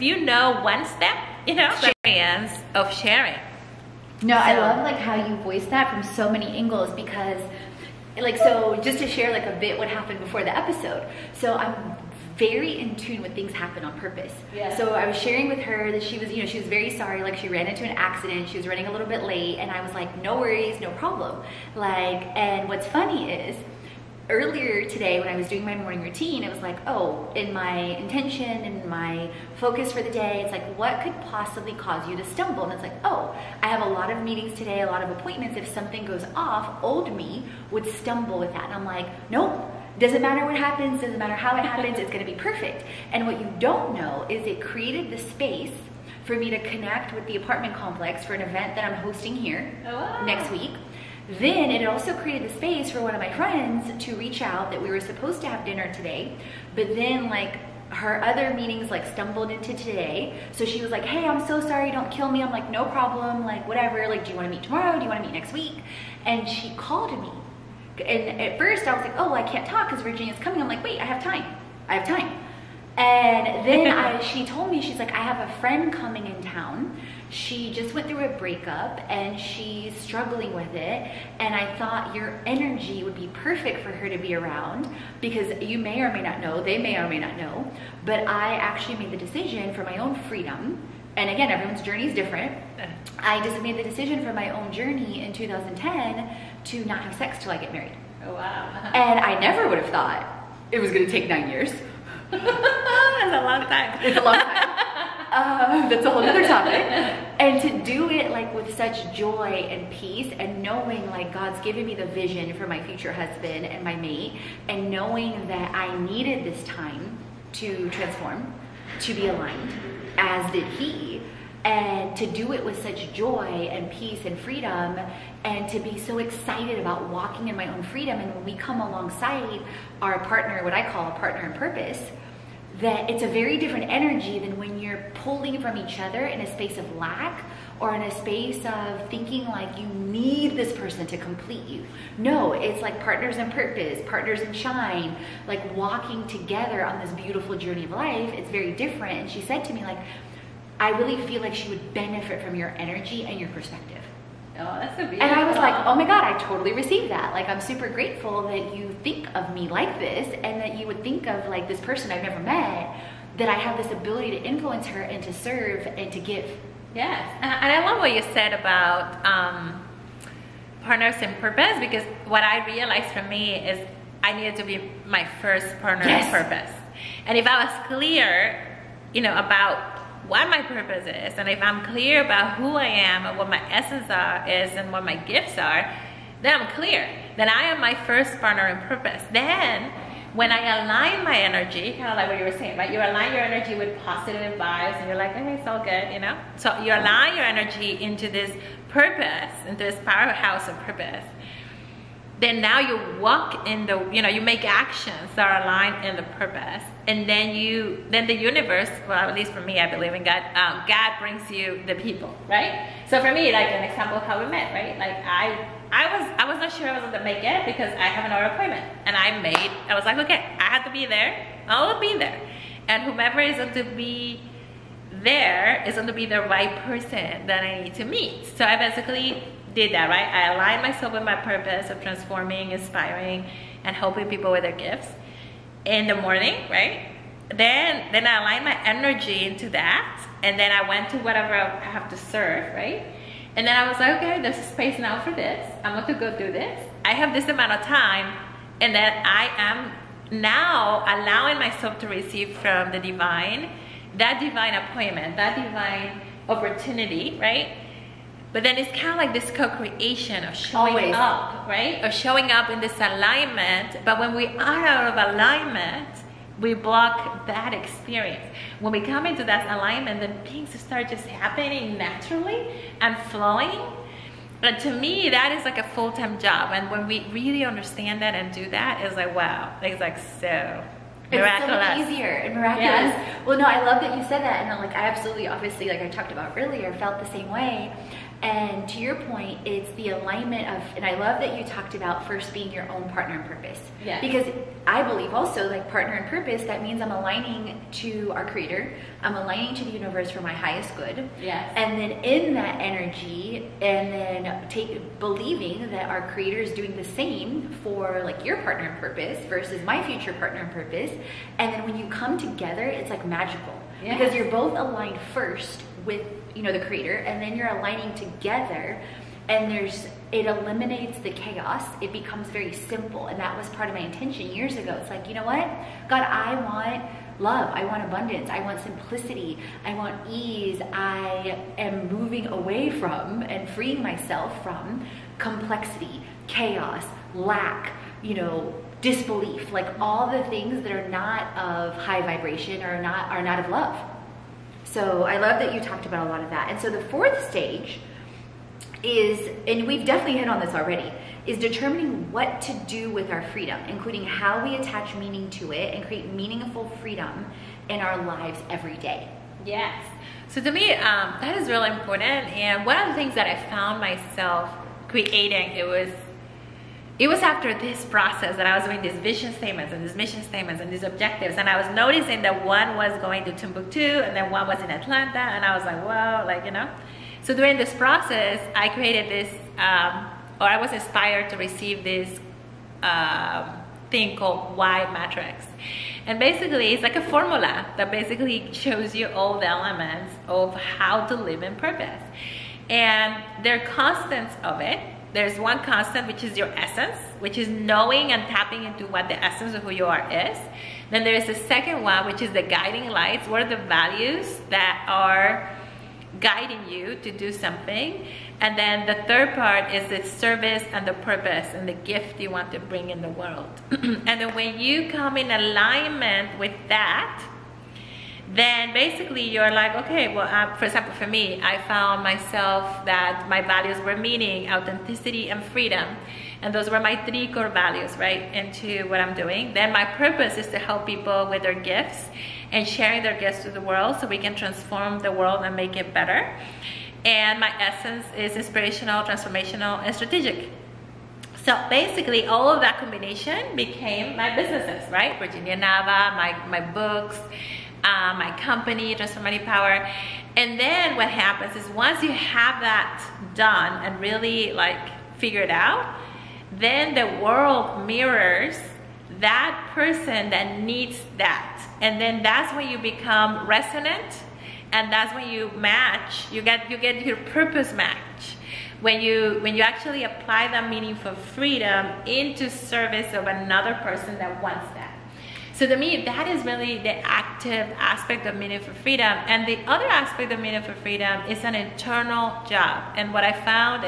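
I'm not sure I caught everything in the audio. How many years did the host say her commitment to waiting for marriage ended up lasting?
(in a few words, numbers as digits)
9.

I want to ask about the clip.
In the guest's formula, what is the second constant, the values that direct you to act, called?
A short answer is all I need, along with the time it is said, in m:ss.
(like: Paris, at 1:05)
guiding lights, at 6:42.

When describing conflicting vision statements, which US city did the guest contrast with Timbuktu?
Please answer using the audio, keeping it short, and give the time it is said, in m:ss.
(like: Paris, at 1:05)
Atlanta, at 6:14.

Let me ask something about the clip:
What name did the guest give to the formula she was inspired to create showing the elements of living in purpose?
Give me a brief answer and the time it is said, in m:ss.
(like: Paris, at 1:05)
Y matrix, at 6:24.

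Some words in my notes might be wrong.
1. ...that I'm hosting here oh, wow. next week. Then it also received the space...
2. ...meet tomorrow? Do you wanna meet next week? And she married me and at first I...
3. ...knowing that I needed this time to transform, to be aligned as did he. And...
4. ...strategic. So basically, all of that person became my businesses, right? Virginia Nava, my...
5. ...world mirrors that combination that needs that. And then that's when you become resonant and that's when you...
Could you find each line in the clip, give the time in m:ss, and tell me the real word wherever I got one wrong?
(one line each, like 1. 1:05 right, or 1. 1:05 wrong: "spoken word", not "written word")
1. 0:48 wrong: "created", not "received"
2. 1:04 wrong: "called", not "married"
3. 1:54 right
4. 7:20 wrong: "combination", not "person"
5. 7:37 wrong: "person", not "combination".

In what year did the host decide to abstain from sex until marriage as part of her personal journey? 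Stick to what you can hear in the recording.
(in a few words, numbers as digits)
2010.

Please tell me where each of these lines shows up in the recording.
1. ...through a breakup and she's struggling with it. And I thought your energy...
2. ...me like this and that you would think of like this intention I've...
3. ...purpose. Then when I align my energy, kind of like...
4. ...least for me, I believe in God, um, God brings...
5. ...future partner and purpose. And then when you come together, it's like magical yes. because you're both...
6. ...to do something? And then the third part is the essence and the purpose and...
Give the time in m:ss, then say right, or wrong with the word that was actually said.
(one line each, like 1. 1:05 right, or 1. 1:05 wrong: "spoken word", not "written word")
1. 1:18 right
2. 2:39 wrong: "person", not "intention"
3. 3:08 right
4. 3:29 right
5. 5:10 right
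6. 6:47 wrong: "service", not "essence".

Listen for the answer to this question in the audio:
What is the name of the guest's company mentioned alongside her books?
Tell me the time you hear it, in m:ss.
7:29.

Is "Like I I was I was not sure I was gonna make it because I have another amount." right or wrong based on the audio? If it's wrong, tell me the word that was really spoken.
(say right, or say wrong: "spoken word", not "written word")
wrong: "appointment", not "amount".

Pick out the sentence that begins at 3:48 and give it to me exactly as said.
So I basically did that, right?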